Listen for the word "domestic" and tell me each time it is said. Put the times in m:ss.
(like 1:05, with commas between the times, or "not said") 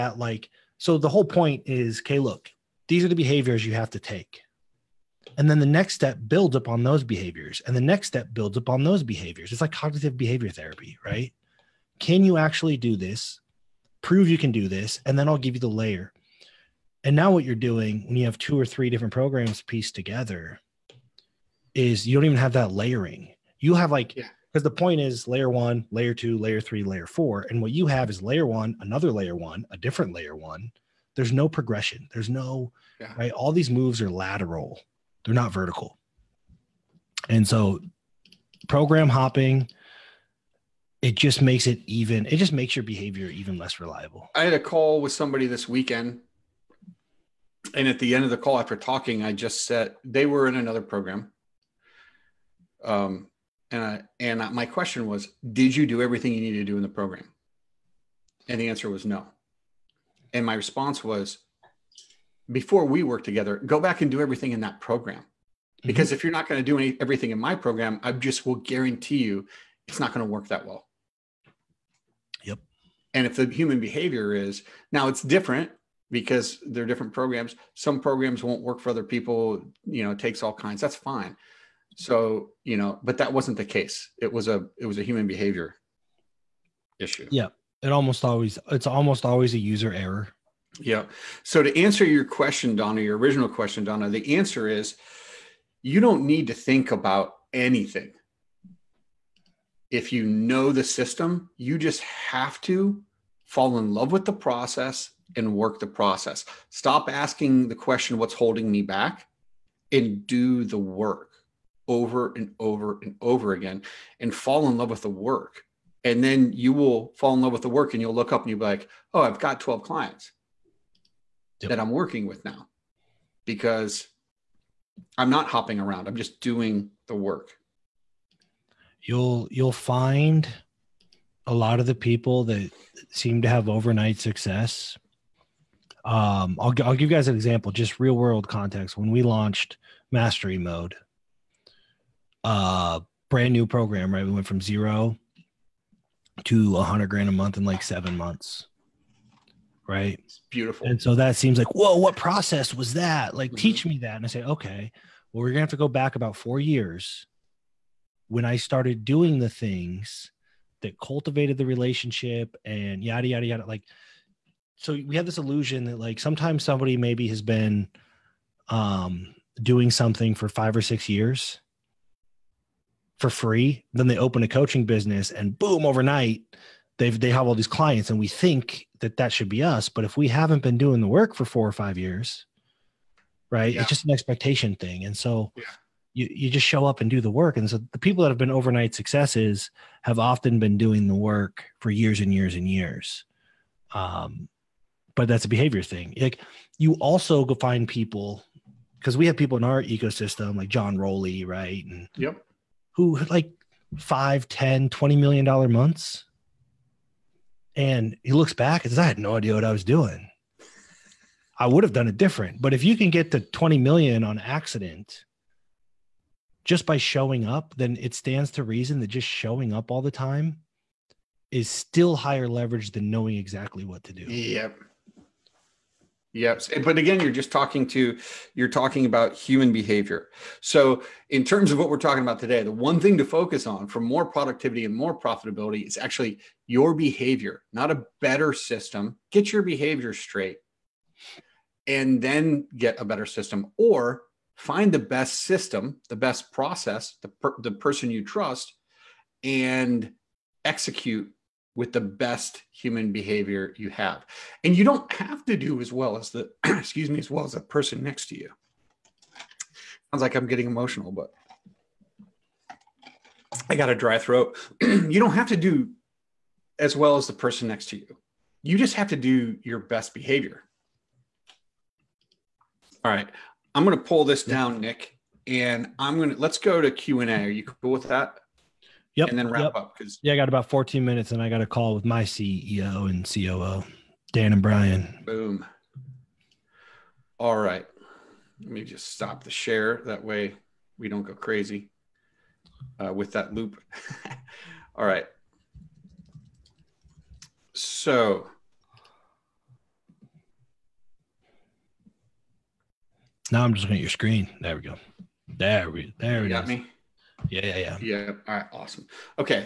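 not said.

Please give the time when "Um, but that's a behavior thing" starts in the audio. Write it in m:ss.
3:13.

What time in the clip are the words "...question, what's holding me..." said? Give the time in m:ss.
1:47.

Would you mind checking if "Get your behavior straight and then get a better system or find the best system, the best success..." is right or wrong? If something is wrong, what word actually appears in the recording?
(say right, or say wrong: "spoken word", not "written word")
wrong: "process", not "success".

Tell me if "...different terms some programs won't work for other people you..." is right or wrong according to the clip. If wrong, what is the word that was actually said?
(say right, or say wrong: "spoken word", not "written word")
wrong: "programs", not "terms".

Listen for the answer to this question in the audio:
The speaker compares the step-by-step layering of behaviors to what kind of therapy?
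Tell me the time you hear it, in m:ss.
0:09.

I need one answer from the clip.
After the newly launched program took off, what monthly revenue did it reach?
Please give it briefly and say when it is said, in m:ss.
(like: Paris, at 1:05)
100 grand a month, at 2:26.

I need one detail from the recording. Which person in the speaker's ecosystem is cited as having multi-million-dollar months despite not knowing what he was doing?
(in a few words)
John Rowley.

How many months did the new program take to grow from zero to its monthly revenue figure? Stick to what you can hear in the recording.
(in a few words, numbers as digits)
7.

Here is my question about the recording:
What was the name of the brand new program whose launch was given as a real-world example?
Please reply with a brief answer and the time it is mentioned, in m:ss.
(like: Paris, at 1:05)
Mastery Mode, at 2:20.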